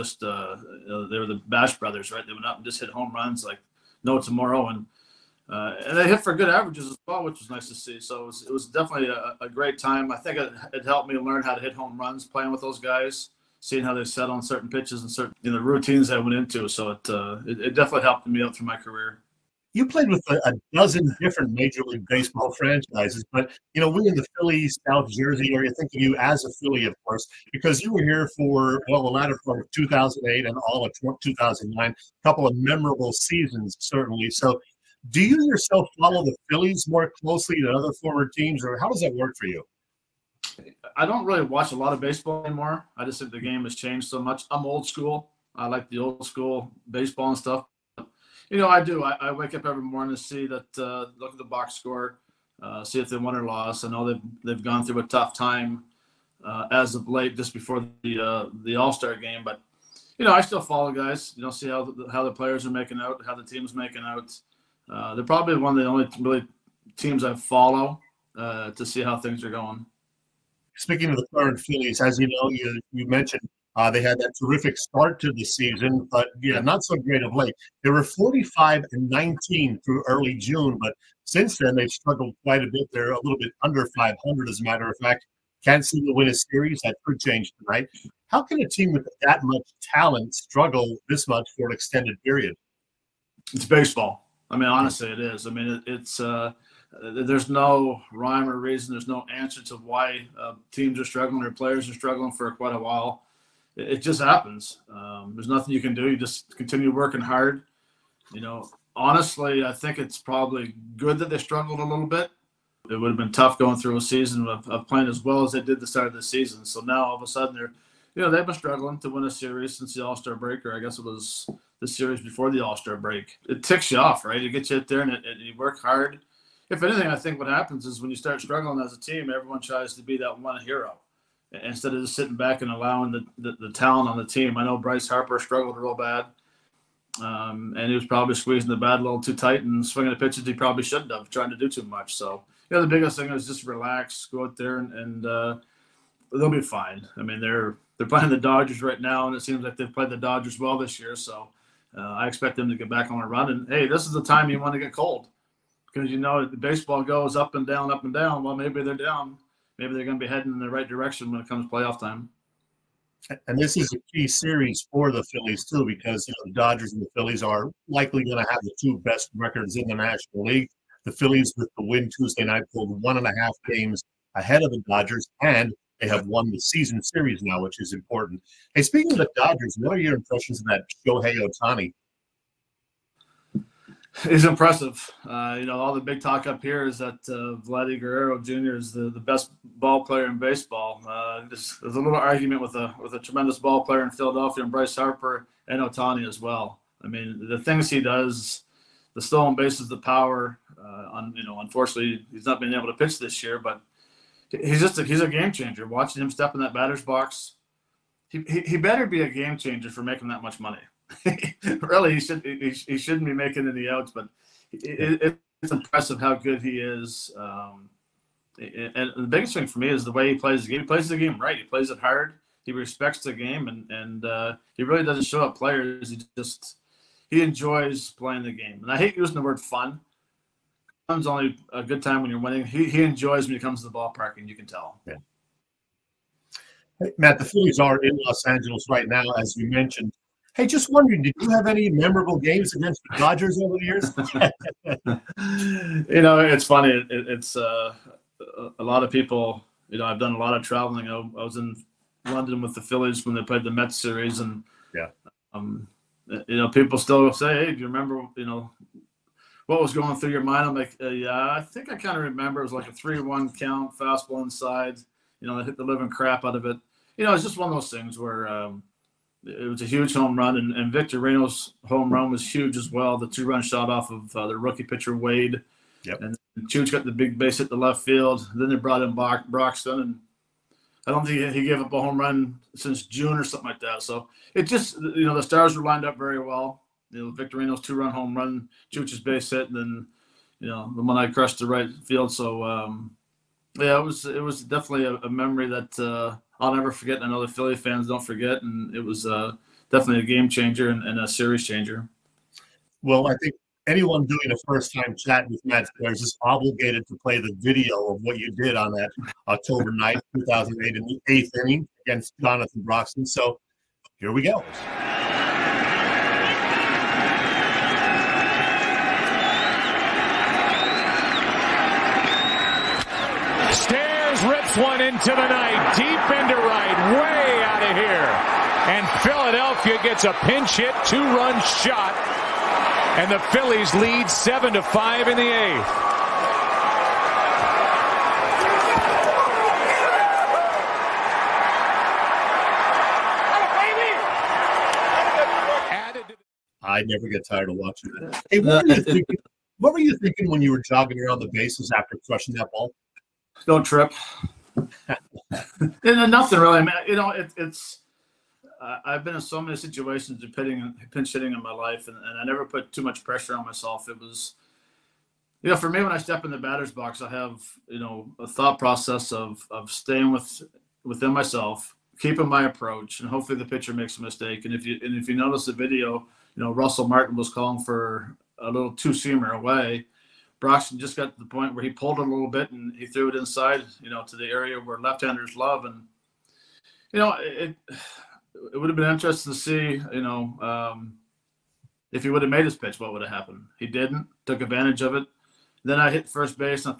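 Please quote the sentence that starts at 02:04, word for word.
It gets you out there and, it, you work hard.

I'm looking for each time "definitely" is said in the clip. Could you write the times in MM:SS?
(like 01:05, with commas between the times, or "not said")
00:08, 00:17, 04:54, 04:59.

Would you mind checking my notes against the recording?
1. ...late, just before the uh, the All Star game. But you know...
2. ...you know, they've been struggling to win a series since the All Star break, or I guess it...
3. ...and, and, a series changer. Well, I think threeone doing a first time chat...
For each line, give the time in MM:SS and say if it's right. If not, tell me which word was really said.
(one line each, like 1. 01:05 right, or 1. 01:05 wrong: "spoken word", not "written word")
1. 00:57 right
2. 01:58 right
3. 05:00 wrong: "anyone", not "threeone".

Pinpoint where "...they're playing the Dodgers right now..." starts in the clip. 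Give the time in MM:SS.
02:27.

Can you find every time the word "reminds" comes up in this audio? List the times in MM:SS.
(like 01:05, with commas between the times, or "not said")
not said.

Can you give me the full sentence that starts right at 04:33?
The two-run shot off of uh, the rookie pitcher Wade.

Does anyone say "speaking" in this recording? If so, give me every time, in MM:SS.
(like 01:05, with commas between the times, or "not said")
01:10, 02:58.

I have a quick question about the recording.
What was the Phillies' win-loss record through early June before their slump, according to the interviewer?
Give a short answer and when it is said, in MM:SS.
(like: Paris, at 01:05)
45 and 19, at 01:18.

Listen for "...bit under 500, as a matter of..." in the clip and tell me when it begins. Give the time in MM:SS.
01:23.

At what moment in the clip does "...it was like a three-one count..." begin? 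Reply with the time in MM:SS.
04:22.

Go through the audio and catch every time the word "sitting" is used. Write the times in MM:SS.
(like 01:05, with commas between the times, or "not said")
02:12.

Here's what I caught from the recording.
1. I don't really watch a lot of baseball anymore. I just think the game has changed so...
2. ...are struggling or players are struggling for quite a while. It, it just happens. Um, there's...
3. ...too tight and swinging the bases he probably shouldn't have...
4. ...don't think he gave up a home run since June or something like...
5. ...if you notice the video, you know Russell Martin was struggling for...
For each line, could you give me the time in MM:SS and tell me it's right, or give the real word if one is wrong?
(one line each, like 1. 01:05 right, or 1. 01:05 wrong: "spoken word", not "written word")
1. 00:40 right
2. 01:40 right
3. 02:19 wrong: "pitches", not "bases"
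4. 04:41 right
5. 06:15 wrong: "calling", not "struggling".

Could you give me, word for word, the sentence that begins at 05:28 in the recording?
And Philadelphia gets a pinch hit, two-run shot, and the Phillies lead seven to five in the eighth.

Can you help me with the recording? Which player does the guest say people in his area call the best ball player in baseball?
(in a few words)
Vladimir Guerrero Jr.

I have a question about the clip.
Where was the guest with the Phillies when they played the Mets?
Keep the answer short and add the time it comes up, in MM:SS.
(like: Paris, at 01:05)
London, at 04:12.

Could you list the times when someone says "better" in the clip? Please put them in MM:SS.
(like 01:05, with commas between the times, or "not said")
03:28.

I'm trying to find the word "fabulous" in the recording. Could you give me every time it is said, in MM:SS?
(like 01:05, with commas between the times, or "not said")
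not said.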